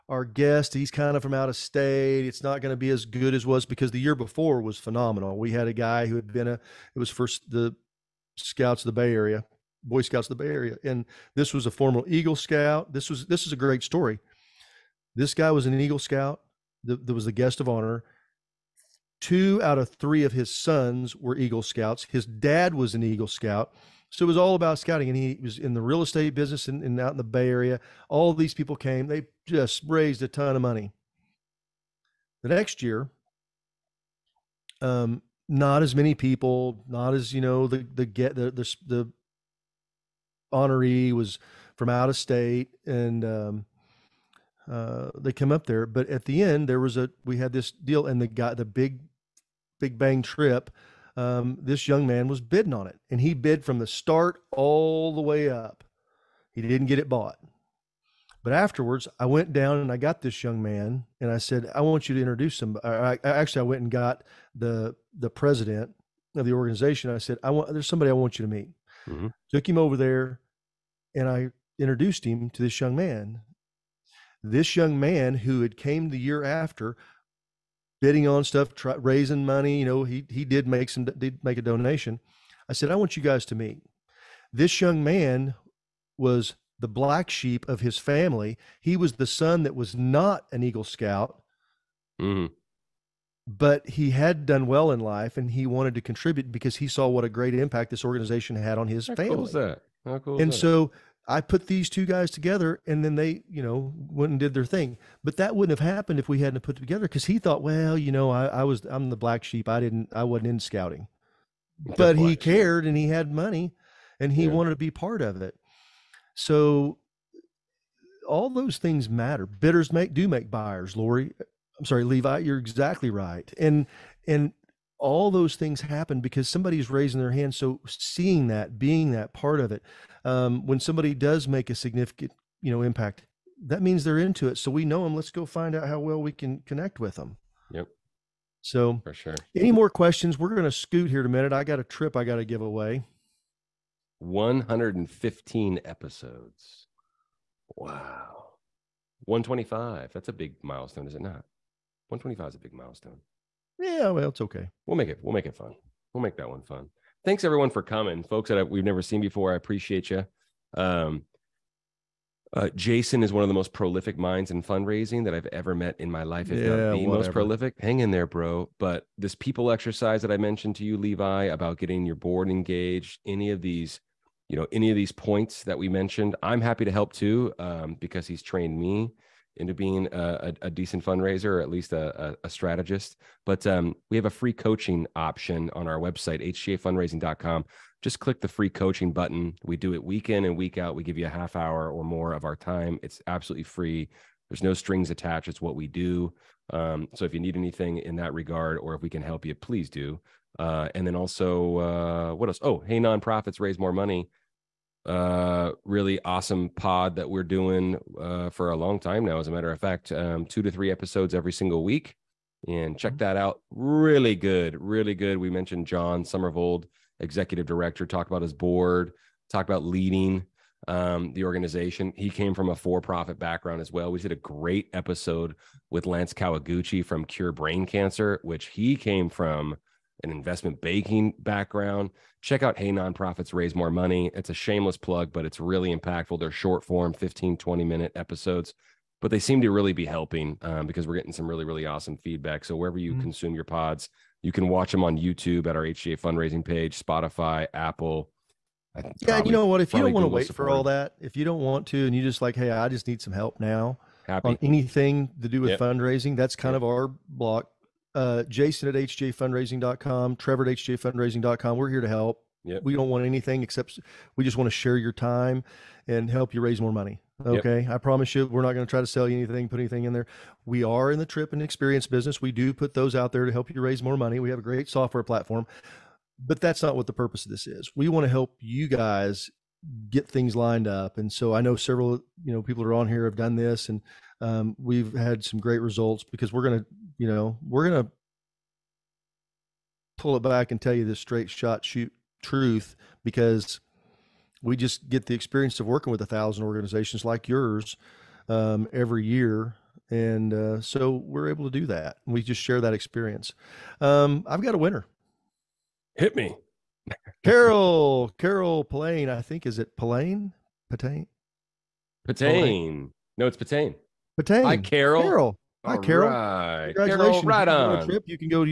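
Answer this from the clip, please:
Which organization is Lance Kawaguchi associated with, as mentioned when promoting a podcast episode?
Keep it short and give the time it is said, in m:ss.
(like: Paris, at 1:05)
Cure Brain Cancer, at 3:47.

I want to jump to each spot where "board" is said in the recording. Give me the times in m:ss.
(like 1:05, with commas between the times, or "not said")
2:52, 3:38.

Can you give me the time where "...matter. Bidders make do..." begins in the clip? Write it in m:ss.
1:59.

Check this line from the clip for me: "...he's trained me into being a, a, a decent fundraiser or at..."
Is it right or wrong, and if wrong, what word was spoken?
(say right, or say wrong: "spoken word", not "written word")
right.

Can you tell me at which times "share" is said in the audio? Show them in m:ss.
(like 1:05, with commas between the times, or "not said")
4:24, 5:02.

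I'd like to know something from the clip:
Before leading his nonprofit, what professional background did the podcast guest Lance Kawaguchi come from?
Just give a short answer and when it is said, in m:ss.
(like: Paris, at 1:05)
Investment banking, at 3:50.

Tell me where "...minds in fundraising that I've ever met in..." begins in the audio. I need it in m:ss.
2:44.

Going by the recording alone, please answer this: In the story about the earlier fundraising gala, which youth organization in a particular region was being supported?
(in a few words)
Boy Scouts of the Bay Area.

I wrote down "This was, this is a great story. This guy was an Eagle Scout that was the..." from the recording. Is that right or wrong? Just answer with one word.
right.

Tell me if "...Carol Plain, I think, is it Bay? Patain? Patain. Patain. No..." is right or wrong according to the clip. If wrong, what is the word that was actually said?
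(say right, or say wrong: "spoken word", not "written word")
wrong: "Plain", not "Bay".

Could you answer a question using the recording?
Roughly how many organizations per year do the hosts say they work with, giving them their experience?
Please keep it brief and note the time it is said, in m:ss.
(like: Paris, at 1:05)
1000, at 4:56.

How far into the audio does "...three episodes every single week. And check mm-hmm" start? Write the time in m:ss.
3:30.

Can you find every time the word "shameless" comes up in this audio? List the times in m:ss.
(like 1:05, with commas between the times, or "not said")
3:54.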